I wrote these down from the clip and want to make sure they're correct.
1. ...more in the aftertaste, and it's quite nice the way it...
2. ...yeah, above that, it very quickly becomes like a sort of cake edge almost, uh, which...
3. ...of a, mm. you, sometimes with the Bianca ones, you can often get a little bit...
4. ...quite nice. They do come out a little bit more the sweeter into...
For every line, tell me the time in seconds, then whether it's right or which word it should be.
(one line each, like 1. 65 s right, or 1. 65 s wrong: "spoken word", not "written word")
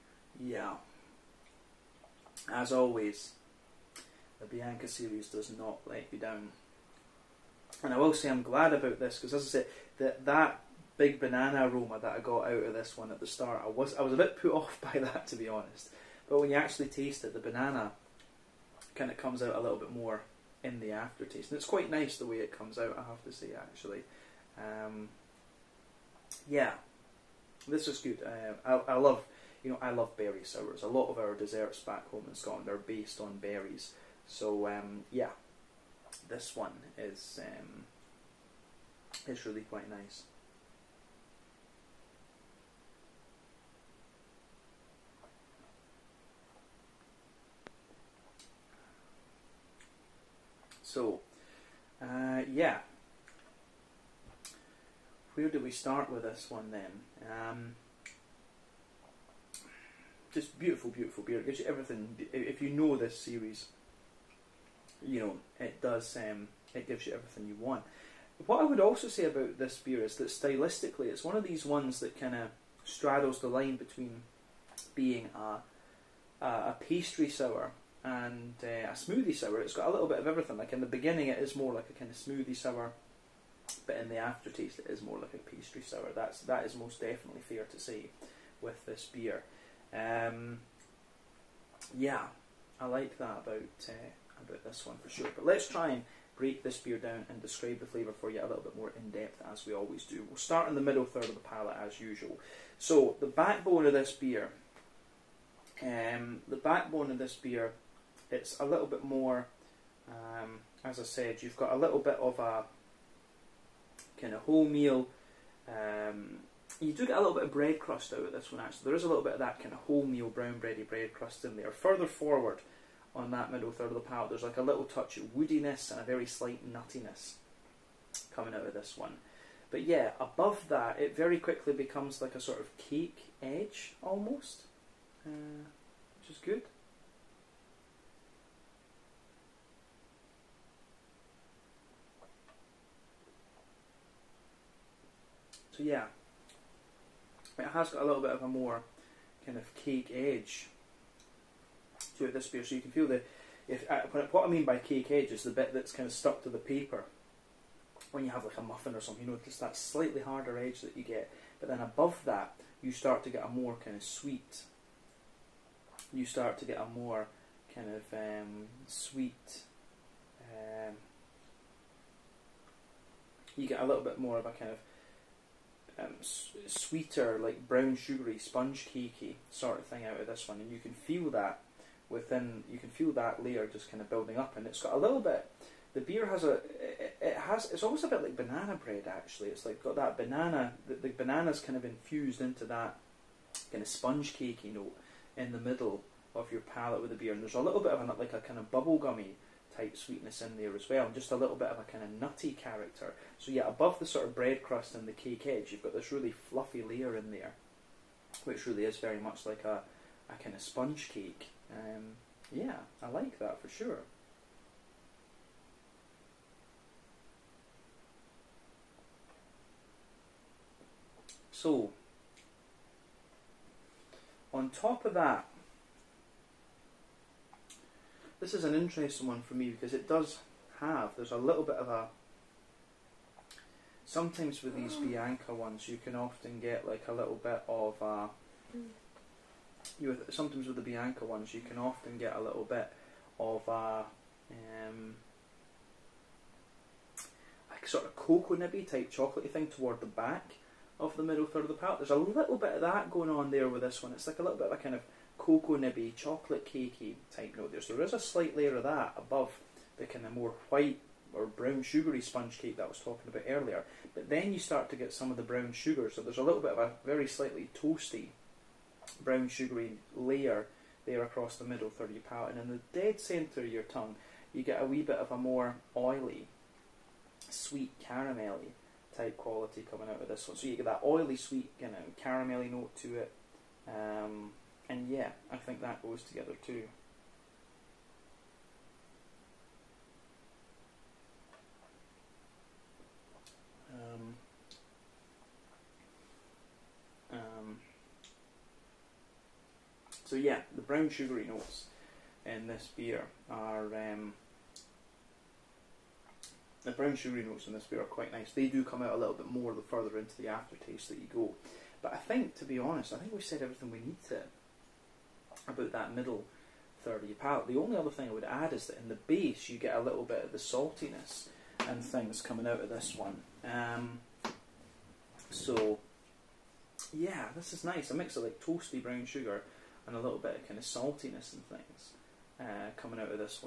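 1. 19 s right
2. 129 s right
3. 237 s right
4. 308 s wrong: "further", not "sweeter".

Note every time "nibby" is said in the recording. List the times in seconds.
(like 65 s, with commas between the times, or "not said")
248 s, 255 s.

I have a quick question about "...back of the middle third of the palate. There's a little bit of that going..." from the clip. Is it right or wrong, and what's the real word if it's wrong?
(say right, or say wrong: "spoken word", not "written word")
right.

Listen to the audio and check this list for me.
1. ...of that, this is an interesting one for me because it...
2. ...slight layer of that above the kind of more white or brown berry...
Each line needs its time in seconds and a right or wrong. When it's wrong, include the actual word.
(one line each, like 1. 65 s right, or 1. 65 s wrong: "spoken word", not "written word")
1. 225 s right
2. 258 s wrong: "sugary", not "berry".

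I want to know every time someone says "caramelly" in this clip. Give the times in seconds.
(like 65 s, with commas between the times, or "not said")
278 s, 282 s.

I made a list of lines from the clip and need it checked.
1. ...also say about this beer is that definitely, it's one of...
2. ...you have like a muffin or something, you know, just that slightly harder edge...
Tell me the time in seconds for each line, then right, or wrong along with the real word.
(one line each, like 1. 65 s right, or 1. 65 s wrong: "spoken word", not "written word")
1. 68 s wrong: "stylistically", not "definitely"
2. 158 s right.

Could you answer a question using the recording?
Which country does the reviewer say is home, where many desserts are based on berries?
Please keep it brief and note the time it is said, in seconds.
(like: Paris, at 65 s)
Scotland, at 32 s.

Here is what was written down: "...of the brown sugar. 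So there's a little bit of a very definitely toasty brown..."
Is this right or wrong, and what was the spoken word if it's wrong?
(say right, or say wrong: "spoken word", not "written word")
wrong: "slightly", not "definitely".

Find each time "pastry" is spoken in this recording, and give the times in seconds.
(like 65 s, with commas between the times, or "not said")
76 s, 85 s.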